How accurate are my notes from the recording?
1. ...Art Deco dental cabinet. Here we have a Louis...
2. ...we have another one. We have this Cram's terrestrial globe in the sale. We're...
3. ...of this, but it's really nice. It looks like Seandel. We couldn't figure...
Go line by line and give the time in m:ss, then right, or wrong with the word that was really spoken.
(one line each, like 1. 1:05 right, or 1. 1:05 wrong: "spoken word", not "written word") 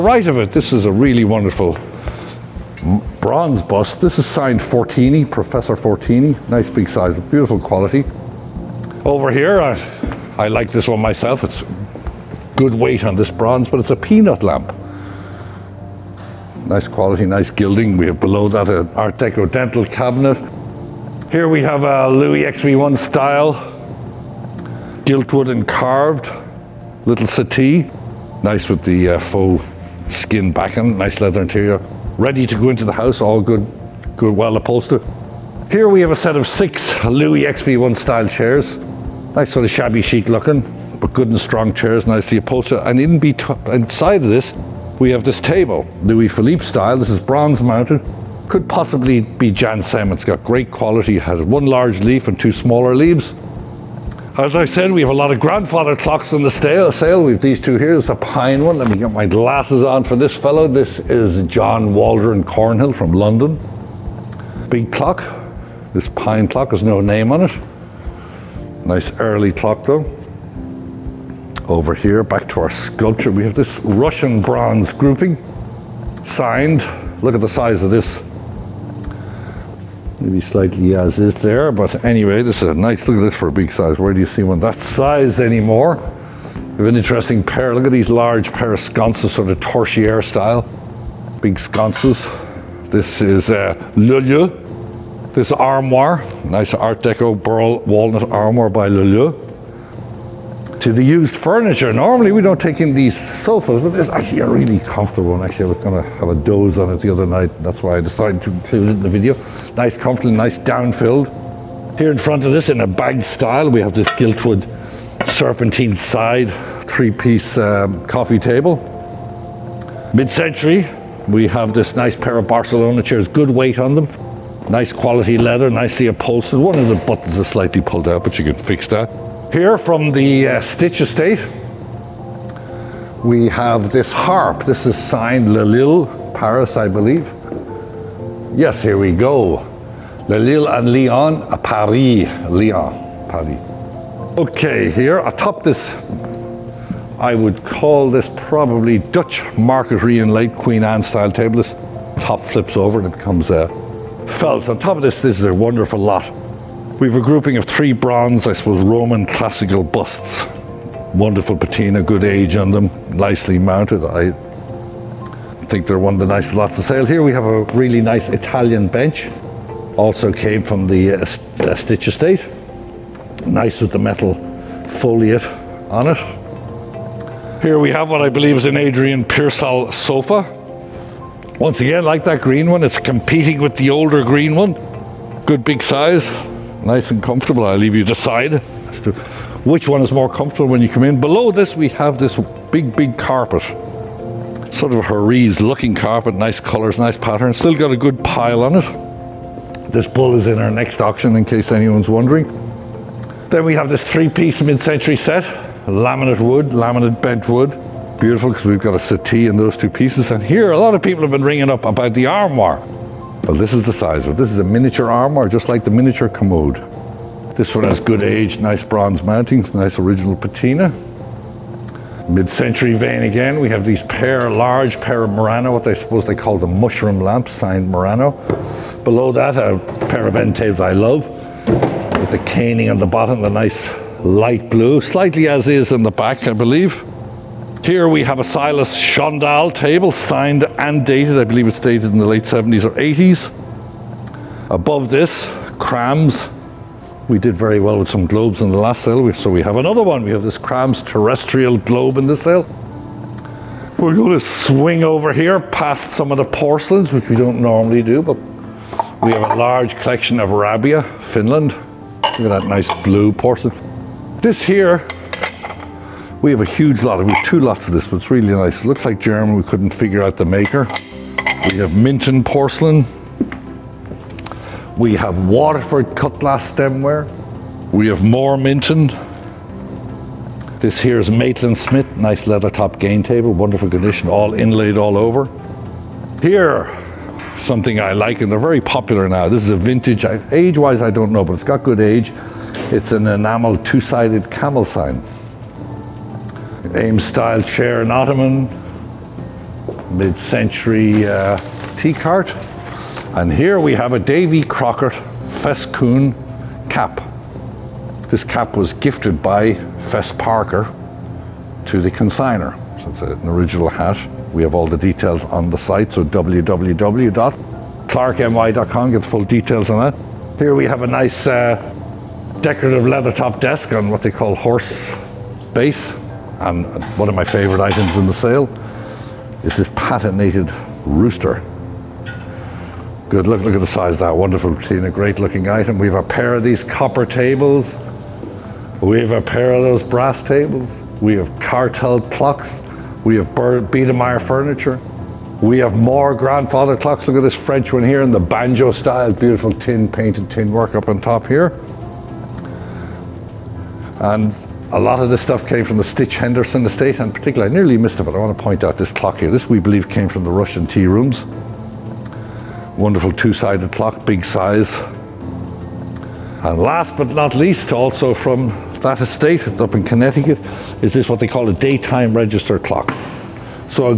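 1. 0:18 right
2. 4:09 right
3. 4:27 wrong: "German", not "Seandel".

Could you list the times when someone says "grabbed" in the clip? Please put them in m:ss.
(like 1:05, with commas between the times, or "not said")
not said.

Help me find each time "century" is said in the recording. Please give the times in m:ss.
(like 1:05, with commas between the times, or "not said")
2:00, 3:24, 3:42, 5:00.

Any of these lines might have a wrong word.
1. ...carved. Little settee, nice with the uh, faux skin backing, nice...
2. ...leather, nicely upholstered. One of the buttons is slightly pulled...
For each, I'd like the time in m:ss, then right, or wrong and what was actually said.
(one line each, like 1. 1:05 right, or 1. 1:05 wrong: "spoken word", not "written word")
1. 0:25 right
2. 2:05 right.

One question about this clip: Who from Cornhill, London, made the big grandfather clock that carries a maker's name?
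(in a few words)
John Waldron.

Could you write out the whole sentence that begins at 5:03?
And here we have a Davy Crockett Fescoon cap.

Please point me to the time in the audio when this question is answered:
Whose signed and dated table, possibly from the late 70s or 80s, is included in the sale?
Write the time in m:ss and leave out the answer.
3:58.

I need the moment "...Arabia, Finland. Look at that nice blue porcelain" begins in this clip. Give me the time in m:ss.
4:20.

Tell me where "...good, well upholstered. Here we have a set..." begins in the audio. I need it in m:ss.
0:34.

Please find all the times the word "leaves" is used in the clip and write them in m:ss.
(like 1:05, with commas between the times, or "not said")
0:52, 3:07.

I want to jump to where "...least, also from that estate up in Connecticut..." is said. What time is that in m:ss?
6:07.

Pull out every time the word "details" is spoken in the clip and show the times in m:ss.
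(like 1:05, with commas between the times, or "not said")
5:14, 5:19.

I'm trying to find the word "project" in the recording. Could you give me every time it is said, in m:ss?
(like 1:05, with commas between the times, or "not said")
not said.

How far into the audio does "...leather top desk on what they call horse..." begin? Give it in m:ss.
5:23.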